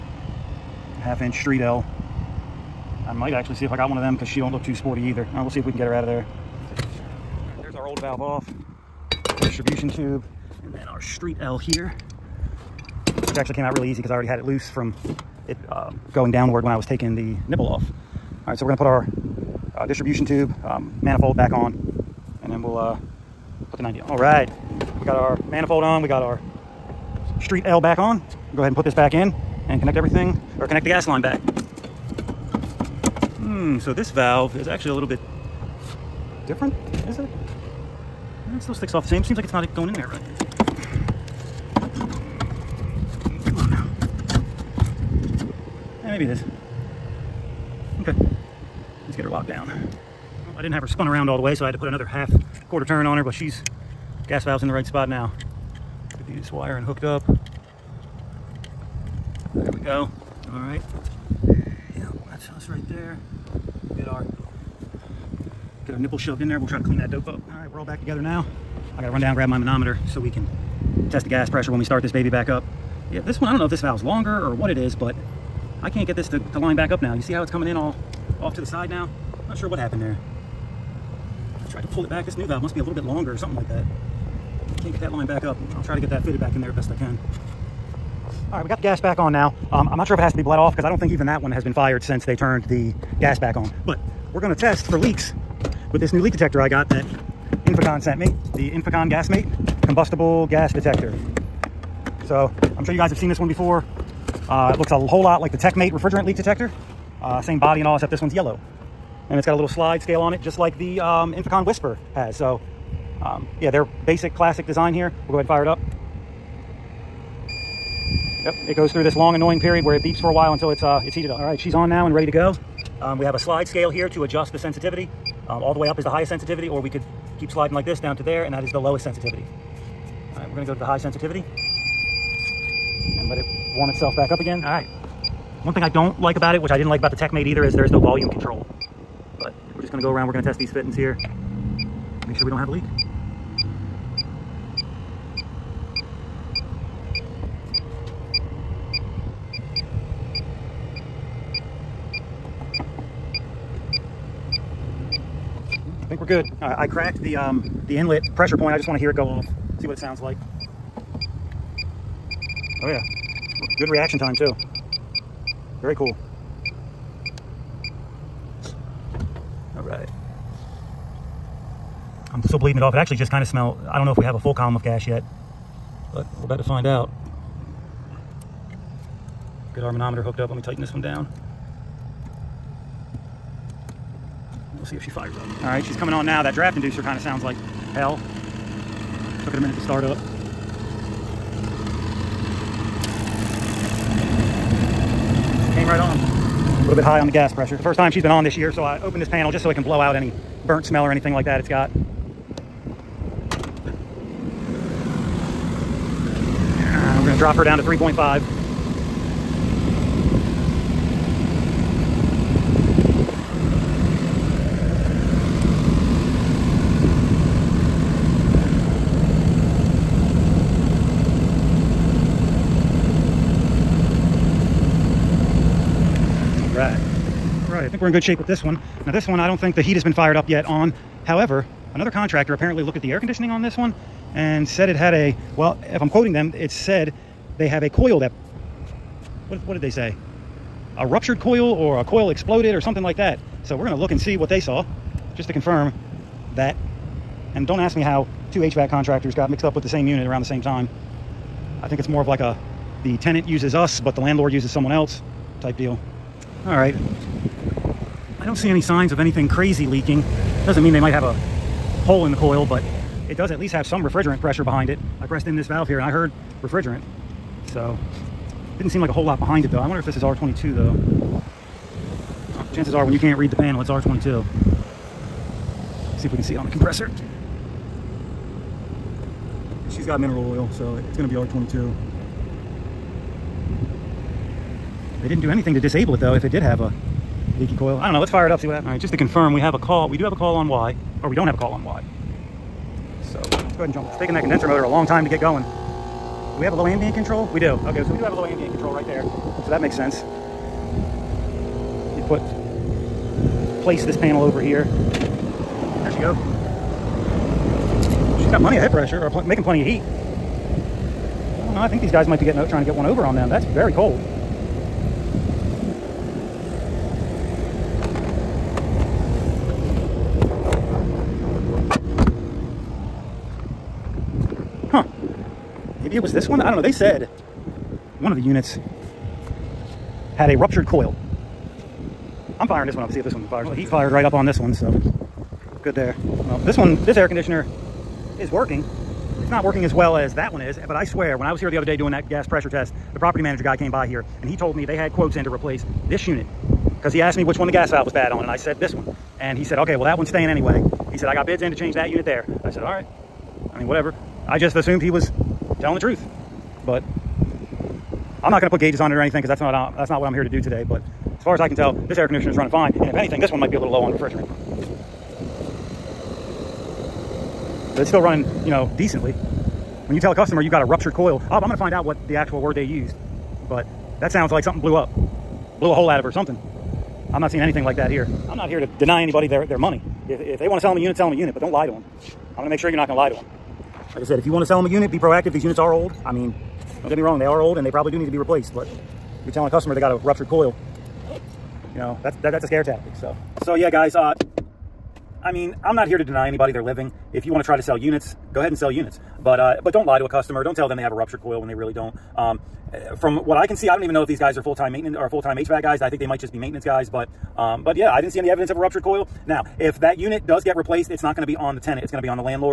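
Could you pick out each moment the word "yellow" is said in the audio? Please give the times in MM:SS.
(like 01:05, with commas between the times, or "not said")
01:48.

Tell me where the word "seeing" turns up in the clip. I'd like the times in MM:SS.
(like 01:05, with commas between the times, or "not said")
06:17.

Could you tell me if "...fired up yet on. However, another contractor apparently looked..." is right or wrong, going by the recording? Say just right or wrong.
right.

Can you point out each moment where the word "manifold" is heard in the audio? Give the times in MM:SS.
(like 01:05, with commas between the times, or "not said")
00:21, 00:25.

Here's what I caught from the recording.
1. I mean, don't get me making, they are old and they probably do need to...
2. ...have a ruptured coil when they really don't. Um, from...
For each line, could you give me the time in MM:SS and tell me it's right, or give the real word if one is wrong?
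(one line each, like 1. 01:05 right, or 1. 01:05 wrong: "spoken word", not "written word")
1. 06:26 wrong: "wrong", not "making"
2. 06:41 right.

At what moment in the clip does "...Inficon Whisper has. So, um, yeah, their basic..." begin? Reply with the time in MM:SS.
01:51.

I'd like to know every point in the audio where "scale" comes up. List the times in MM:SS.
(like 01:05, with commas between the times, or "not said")
01:50, 02:03.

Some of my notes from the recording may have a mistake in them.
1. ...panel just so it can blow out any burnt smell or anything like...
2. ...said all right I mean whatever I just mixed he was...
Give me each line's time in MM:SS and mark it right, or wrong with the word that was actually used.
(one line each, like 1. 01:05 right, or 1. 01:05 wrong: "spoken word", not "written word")
1. 03:19 right
2. 05:52 wrong: "assumed", not "mixed".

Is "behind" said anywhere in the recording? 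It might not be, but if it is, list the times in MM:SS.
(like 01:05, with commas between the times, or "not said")
04:24, 04:29.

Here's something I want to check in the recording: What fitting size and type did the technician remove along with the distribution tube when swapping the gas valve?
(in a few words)
Half inch street L.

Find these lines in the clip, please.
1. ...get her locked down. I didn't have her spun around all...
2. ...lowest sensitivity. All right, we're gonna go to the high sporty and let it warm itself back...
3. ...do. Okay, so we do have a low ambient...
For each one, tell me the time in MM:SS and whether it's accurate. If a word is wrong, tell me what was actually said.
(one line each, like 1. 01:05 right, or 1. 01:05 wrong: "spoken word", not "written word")
1. 00:49 right
2. 02:08 wrong: "sensitivity", not "sporty"
3. 04:57 right.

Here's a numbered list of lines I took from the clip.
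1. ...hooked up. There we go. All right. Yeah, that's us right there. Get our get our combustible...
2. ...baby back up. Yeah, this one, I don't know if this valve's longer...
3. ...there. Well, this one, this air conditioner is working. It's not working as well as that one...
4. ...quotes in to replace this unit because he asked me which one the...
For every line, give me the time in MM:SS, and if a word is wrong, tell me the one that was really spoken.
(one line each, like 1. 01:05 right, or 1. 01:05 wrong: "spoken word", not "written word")
1. 00:56 wrong: "nipple", not "combustible"
2. 01:12 right
3. 05:35 right
4. 05:45 right.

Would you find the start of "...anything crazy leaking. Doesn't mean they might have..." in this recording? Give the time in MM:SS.
04:19.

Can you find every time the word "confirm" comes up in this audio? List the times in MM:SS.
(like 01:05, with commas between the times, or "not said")
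04:05, 04:49.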